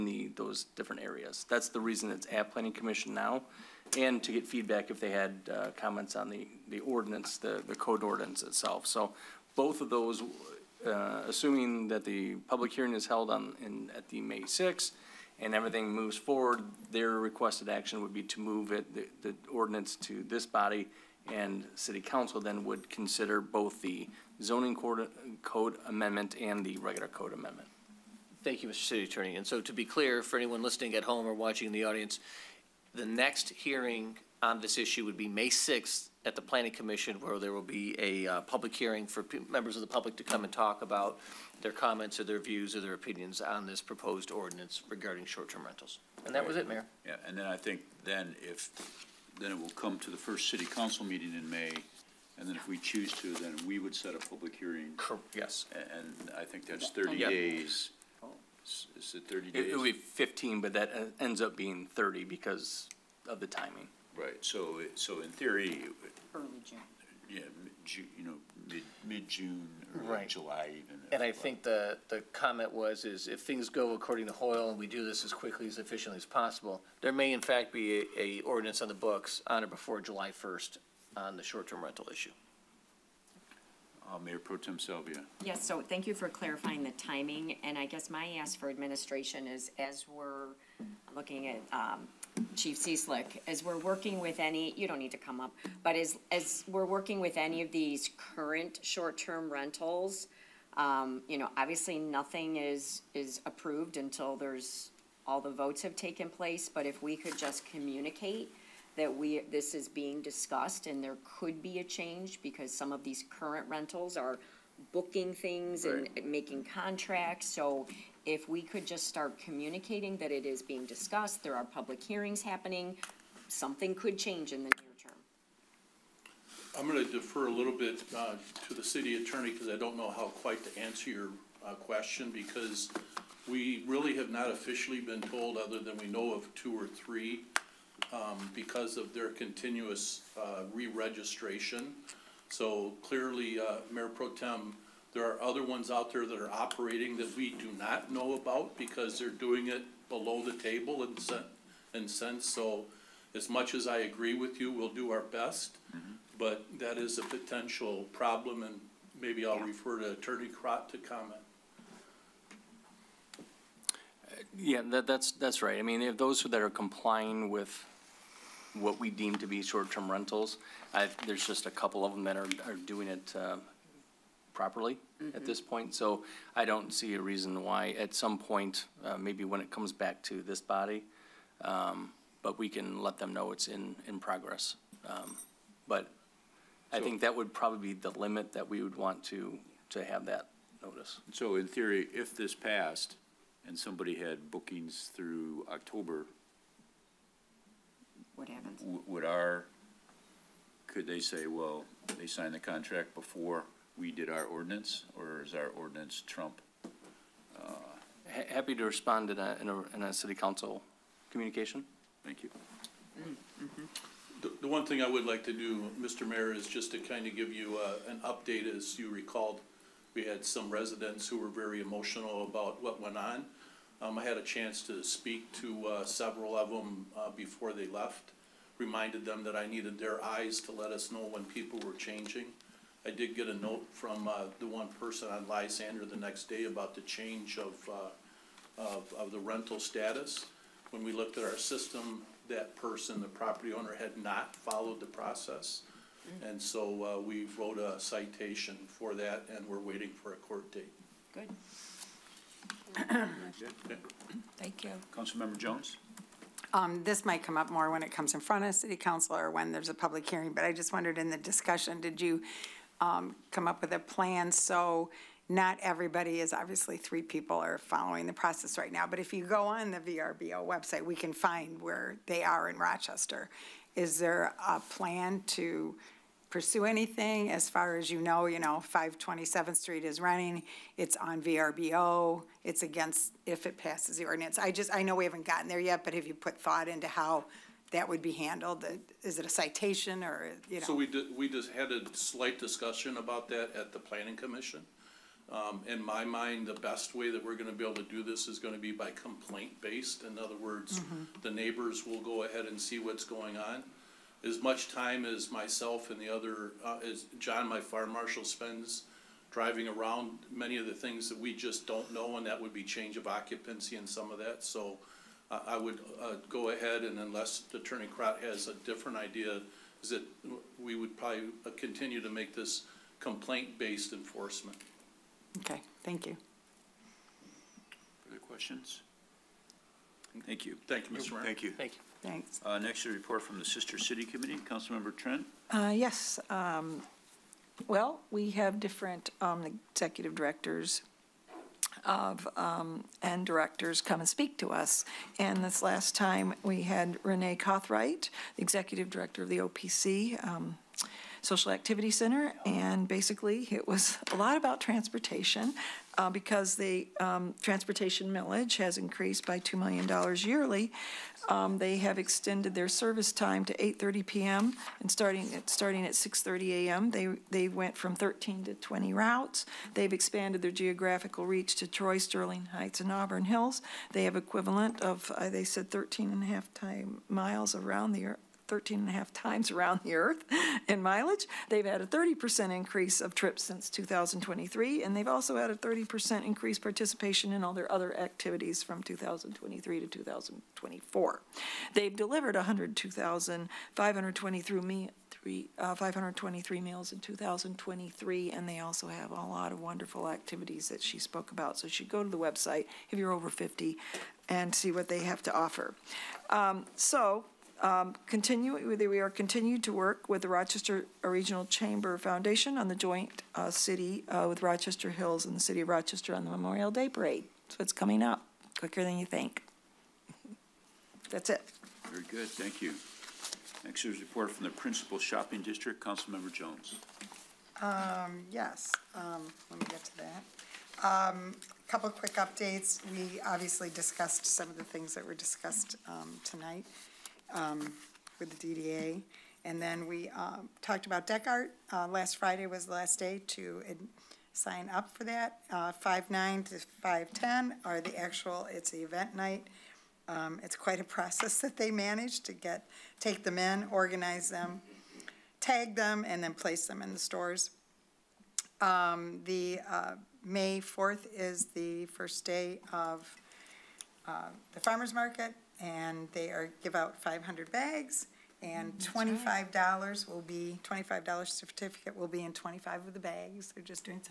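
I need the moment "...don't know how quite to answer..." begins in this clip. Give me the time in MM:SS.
02:09.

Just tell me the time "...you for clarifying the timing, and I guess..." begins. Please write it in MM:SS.
01:26.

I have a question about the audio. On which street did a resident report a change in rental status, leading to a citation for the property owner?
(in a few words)
Lysander.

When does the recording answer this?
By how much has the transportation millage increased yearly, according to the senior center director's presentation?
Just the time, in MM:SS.
05:59.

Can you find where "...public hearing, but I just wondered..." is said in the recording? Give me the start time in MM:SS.
04:19.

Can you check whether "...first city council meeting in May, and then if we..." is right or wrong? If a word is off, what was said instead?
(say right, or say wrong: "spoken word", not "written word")
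right.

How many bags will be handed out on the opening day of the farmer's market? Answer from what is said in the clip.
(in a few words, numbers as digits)
500.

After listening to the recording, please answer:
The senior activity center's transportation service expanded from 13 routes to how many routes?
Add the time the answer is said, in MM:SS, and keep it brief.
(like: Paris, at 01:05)
20, at 06:08.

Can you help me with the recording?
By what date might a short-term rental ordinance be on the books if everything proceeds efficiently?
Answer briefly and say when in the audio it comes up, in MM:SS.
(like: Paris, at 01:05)
July 1st, at 01:19.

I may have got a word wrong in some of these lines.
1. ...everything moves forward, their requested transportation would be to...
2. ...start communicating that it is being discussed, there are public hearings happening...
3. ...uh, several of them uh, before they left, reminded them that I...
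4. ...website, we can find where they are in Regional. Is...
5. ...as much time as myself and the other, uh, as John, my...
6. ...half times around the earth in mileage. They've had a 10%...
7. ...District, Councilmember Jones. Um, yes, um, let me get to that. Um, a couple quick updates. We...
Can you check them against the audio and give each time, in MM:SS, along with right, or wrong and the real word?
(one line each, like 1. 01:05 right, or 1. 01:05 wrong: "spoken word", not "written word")
1. 00:15 wrong: "action", not "transportation"
2. 01:59 right
3. 03:45 right
4. 04:30 wrong: "Rochester", not "Regional"
5. 05:04 right
6. 06:19 wrong: "30", not "10"
7. 07:05 right.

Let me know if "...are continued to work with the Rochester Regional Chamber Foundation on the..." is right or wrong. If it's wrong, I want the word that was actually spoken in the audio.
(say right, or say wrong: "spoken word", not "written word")
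right.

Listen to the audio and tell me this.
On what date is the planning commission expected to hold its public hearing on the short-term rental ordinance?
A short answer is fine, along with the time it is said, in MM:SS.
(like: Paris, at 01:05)
May 6th, at 00:35.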